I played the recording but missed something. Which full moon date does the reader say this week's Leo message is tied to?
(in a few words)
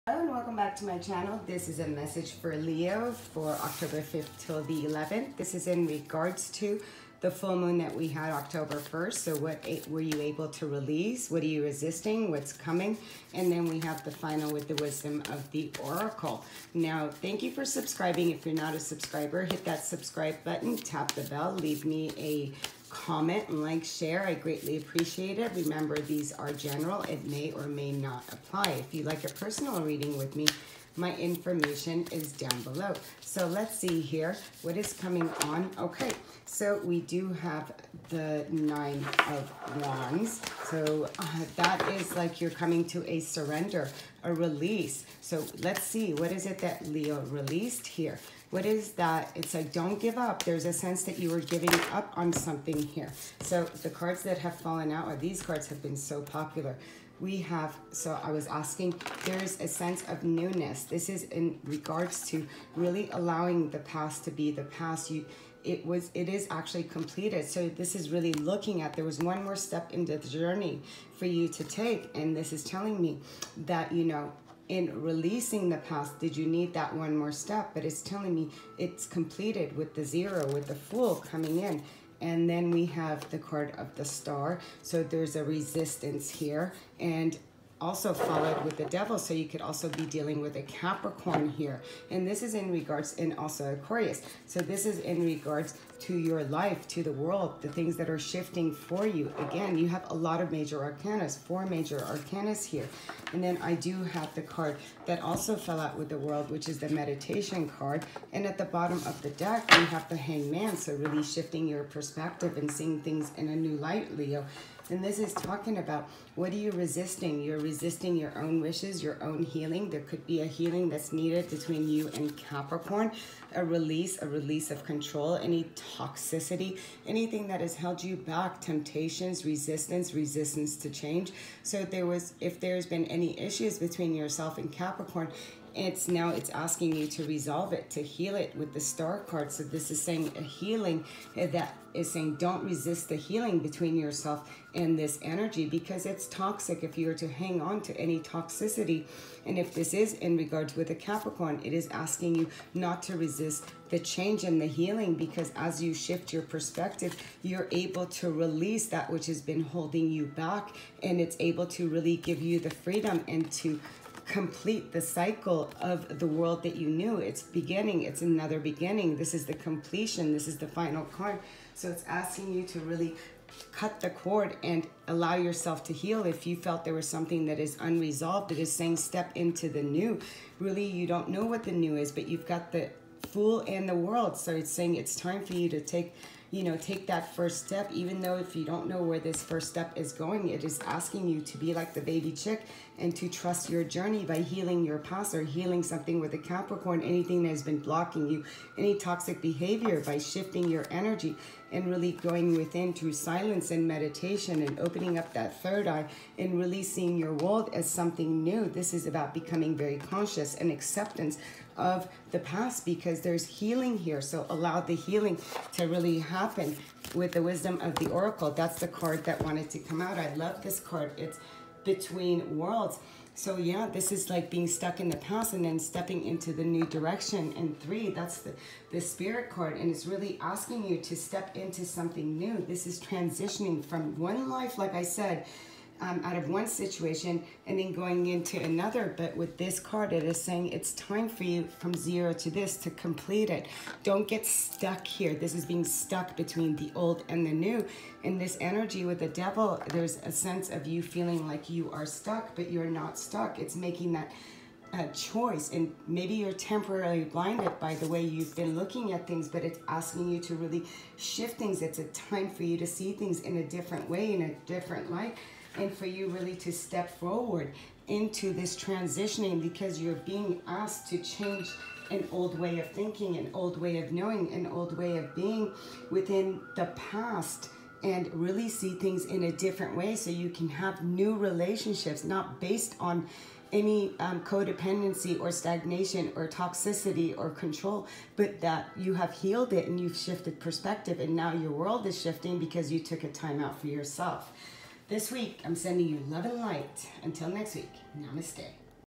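October 1st.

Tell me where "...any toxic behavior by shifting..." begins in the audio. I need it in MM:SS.
03:18.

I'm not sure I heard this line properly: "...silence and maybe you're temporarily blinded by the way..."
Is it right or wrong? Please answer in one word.
wrong.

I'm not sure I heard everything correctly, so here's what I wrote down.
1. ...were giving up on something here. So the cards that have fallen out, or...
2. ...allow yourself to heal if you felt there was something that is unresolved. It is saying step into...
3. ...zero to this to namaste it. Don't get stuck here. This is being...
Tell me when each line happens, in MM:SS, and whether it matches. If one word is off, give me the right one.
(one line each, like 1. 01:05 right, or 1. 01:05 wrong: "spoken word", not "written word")
1. 00:51 right
2. 02:55 right
3. 04:01 wrong: "complete", not "namaste".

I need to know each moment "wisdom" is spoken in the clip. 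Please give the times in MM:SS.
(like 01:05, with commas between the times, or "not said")
00:14, 03:37.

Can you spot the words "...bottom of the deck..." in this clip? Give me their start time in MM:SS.
01:48.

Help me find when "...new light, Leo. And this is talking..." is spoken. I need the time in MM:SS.
01:53.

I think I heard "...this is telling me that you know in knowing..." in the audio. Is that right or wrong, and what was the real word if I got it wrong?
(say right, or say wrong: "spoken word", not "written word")
wrong: "releasing", not "knowing".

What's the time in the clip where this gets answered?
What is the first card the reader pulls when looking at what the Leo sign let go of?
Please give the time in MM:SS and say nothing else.
00:38.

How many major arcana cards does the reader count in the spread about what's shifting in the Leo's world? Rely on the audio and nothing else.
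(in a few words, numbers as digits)
4.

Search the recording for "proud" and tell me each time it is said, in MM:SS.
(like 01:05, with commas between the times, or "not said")
not said.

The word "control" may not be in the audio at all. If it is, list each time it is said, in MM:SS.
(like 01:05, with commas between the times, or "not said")
02:04, 04:47.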